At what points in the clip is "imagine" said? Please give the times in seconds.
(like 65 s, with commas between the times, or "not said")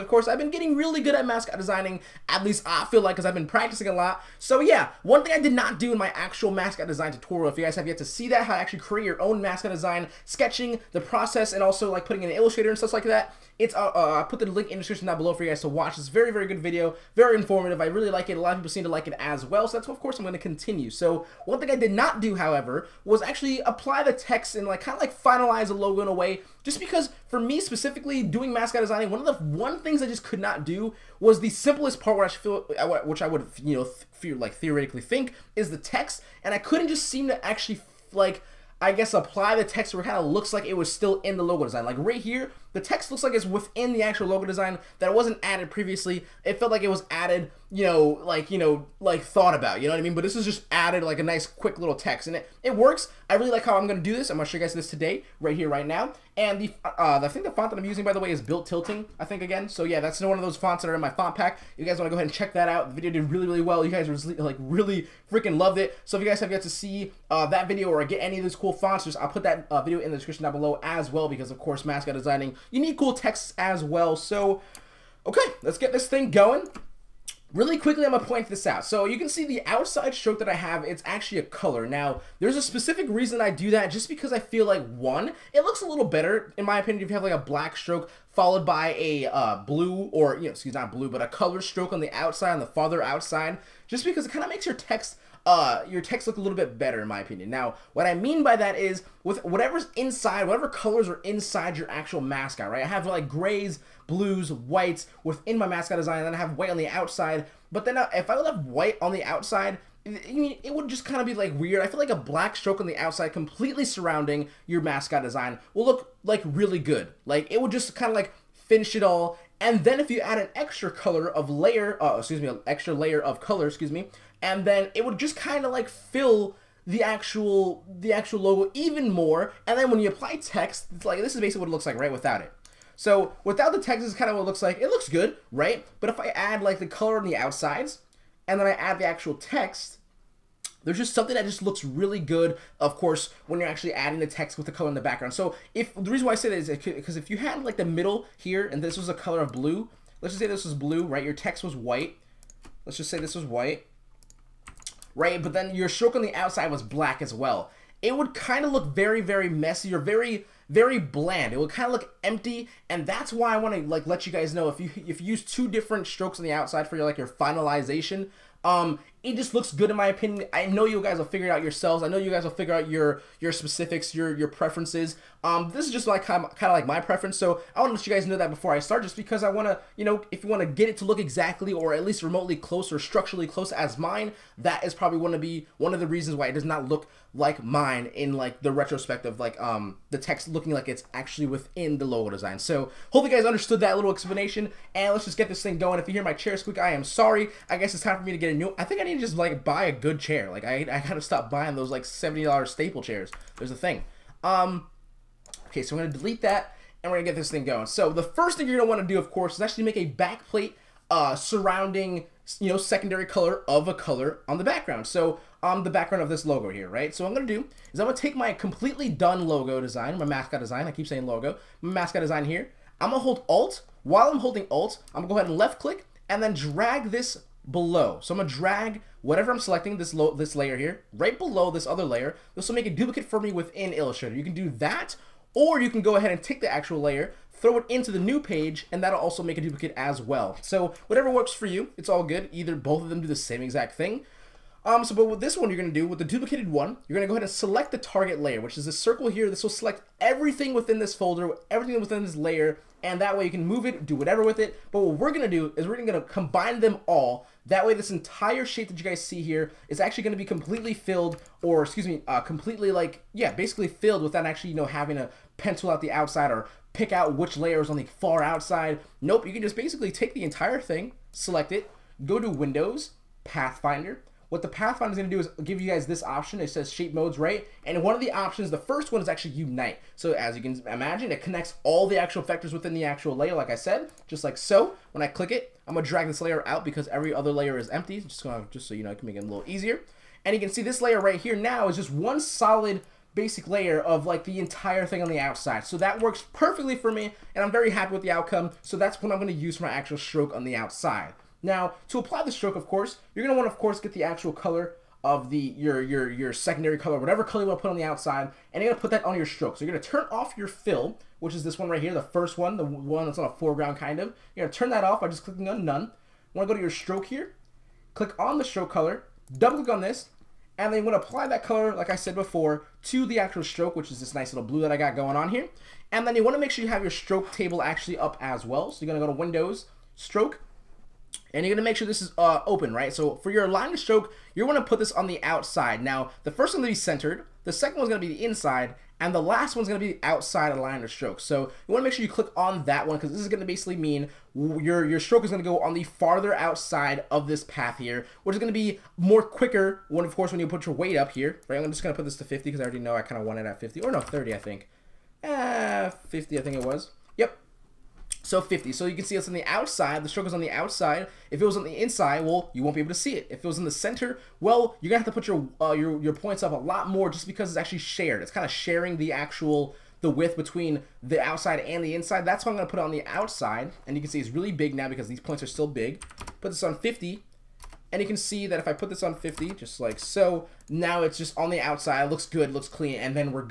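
280 s.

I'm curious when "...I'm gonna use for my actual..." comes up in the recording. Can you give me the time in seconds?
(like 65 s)
299 s.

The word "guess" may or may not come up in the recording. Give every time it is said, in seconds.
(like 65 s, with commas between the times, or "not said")
38 s, 197 s.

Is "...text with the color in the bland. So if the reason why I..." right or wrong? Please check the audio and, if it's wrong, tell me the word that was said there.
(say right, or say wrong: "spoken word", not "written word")
wrong: "background", not "bland".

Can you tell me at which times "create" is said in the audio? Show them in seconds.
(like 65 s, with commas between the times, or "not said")
8 s.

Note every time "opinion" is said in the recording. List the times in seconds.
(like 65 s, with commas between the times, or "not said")
86 s, 97 s, 170 s.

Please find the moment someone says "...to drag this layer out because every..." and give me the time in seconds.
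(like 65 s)
286 s.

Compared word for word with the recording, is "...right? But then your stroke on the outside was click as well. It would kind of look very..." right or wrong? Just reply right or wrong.
wrong.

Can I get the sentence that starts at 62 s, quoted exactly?
The video did really, really well.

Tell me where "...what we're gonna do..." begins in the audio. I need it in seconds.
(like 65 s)
255 s.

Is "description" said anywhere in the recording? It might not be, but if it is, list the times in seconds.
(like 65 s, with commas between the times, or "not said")
14 s, 70 s.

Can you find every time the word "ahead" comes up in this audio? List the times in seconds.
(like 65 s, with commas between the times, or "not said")
62 s, 225 s, 236 s, 247 s.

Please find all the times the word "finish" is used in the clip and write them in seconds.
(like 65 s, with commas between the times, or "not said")
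118 s.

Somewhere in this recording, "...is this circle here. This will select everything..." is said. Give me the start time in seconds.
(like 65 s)
248 s.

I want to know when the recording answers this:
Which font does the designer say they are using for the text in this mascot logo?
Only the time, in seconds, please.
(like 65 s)
58 s.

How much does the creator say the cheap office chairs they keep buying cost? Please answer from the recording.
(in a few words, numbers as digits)
$70.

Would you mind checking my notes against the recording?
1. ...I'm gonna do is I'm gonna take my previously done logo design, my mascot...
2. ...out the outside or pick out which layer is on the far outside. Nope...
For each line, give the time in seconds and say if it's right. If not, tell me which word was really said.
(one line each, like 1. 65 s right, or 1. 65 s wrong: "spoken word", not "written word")
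1. 217 s wrong: "completely", not "previously"
2. 265 s right.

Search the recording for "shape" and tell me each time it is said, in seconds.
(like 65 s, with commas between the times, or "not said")
258 s, 276 s.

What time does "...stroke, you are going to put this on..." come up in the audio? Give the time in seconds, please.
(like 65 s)
333 s.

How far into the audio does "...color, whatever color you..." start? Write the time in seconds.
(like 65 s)
306 s.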